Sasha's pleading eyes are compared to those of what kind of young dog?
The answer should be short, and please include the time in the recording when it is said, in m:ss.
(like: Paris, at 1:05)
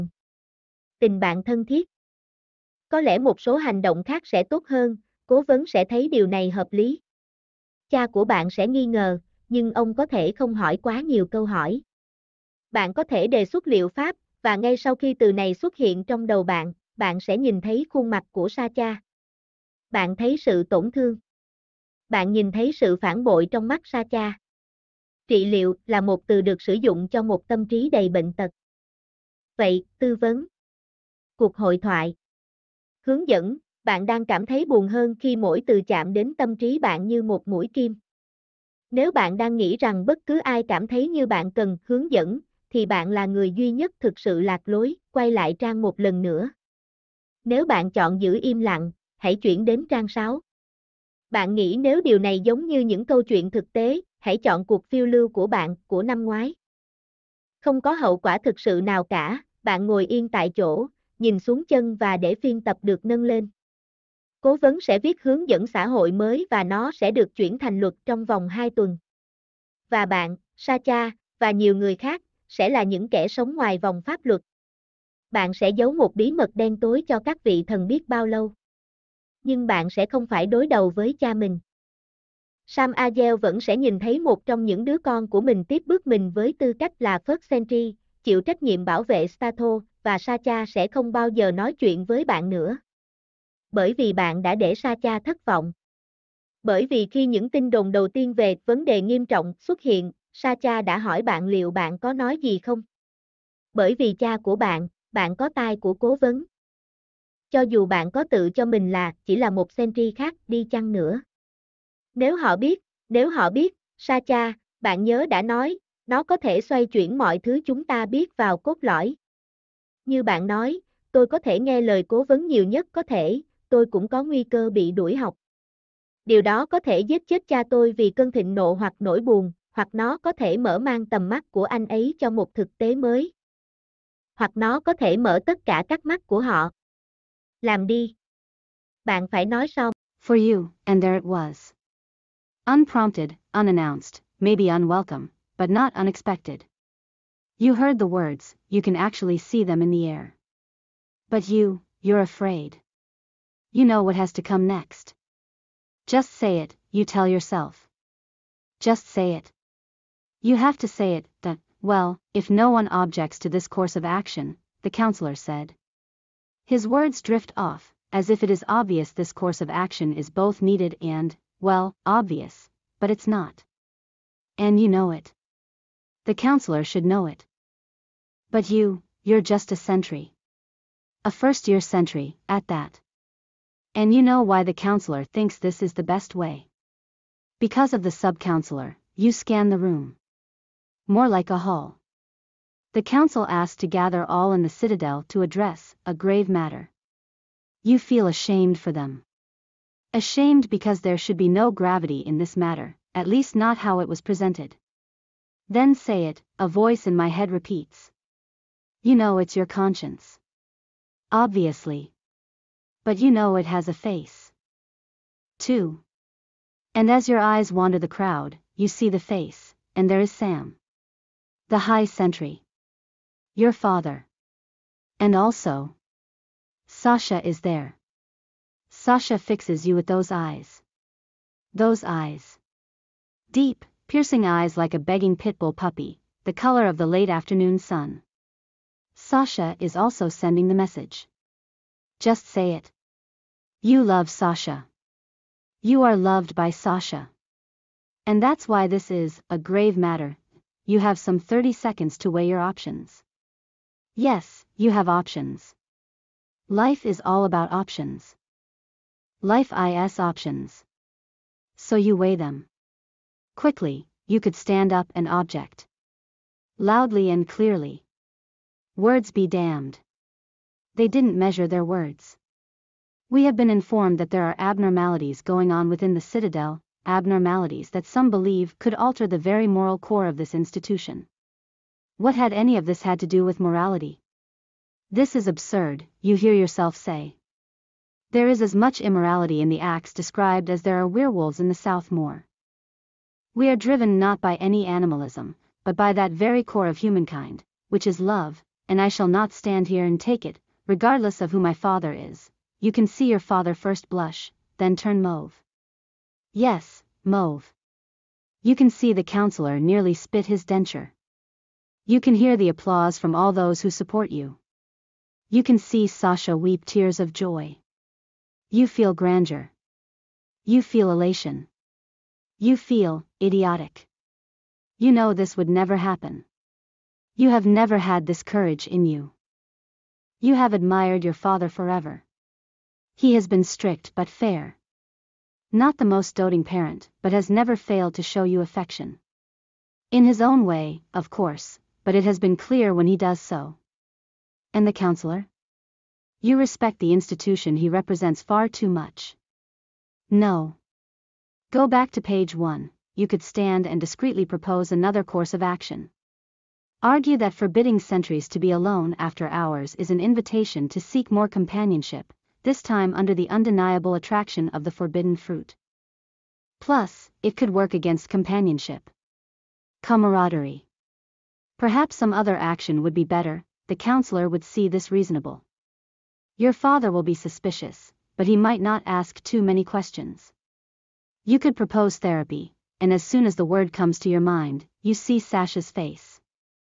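pit bull puppy, at 3:55.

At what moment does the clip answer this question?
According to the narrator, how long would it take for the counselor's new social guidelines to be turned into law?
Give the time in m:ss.
1:08.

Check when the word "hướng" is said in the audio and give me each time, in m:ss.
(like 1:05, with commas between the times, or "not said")
0:33, 0:41, 1:05.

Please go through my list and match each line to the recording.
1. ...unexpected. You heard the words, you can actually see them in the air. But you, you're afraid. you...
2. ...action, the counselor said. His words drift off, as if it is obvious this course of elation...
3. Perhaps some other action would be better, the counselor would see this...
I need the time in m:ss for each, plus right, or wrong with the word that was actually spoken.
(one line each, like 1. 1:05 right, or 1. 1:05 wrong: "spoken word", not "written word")
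1. 2:25 right
2. 2:44 wrong: "action", not "elation"
3. 6:11 right.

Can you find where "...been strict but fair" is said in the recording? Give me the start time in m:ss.
5:33.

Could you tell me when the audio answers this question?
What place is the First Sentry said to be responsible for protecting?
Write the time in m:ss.
1:29.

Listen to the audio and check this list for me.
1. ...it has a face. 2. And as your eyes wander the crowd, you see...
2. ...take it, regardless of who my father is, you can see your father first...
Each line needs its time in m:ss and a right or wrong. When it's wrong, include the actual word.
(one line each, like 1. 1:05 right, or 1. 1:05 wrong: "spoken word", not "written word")
1. 3:33 right
2. 5:00 right.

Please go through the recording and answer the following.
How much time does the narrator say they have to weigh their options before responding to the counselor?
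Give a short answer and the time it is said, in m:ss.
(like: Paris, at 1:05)
30 seconds, at 4:11.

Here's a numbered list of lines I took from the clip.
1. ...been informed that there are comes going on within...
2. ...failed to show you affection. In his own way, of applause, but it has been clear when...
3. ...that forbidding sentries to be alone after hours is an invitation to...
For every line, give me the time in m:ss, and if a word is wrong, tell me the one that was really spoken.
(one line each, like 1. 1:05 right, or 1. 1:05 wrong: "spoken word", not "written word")
1. 4:33 wrong: "abnormalities", not "comes"
2. 5:37 wrong: "course", not "applause"
3. 5:57 right.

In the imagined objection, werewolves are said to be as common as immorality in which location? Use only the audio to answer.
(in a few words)
South Moor.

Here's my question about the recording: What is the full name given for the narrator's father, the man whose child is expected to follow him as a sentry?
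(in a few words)
Sam Agel.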